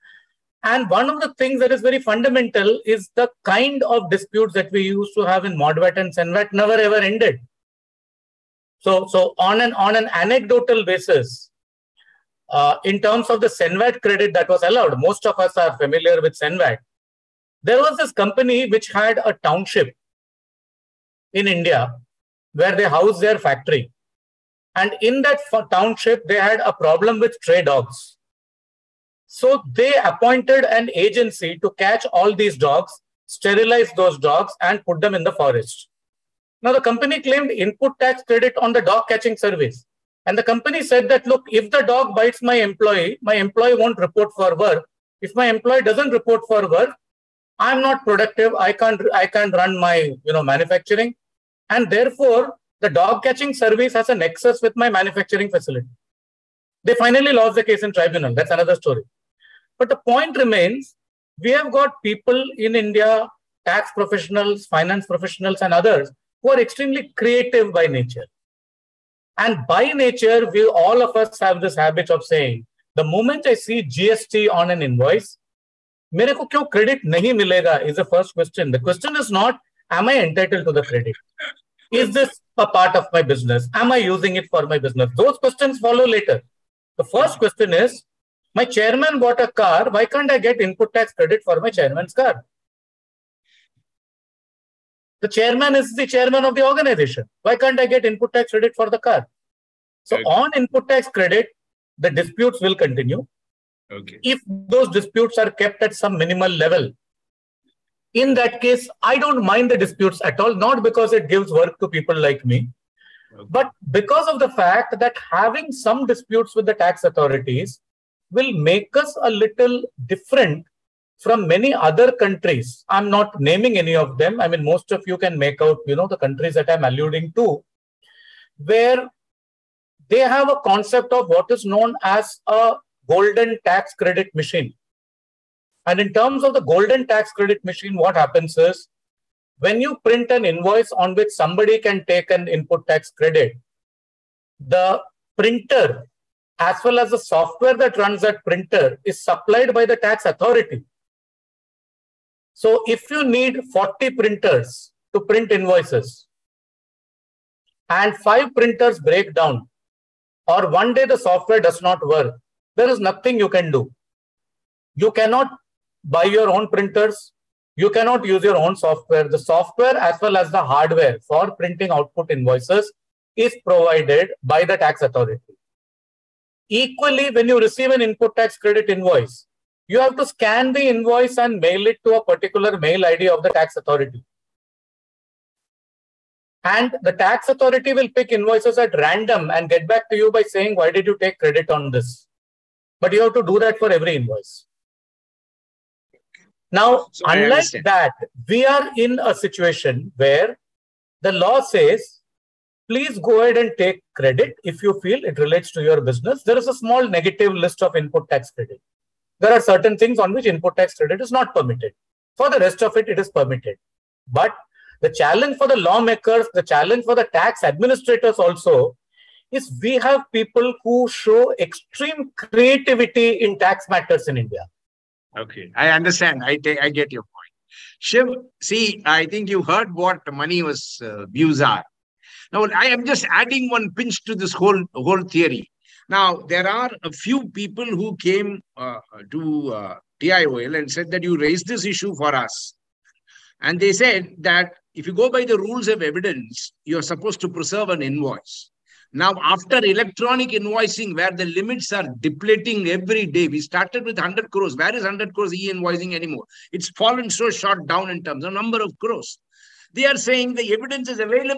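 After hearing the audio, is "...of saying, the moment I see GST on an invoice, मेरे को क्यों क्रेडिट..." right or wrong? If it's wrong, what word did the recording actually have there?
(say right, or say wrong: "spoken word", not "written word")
right.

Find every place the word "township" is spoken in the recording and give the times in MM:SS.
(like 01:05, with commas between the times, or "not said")
00:19, 00:25.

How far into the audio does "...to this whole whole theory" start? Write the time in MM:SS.
03:54.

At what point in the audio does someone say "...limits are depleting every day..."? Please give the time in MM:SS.
04:11.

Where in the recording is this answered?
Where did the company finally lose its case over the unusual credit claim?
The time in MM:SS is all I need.
00:57.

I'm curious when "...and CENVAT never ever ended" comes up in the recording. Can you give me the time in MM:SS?
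00:05.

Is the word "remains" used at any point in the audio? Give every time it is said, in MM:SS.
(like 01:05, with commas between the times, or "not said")
01:00.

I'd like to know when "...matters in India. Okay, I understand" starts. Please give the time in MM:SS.
03:43.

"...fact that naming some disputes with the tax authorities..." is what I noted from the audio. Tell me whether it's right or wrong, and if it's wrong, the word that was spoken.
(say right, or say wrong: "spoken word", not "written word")
wrong: "having", not "naming".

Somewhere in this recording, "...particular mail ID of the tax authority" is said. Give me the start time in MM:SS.
03:02.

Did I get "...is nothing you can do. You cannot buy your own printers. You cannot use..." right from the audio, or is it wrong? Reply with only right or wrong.
right.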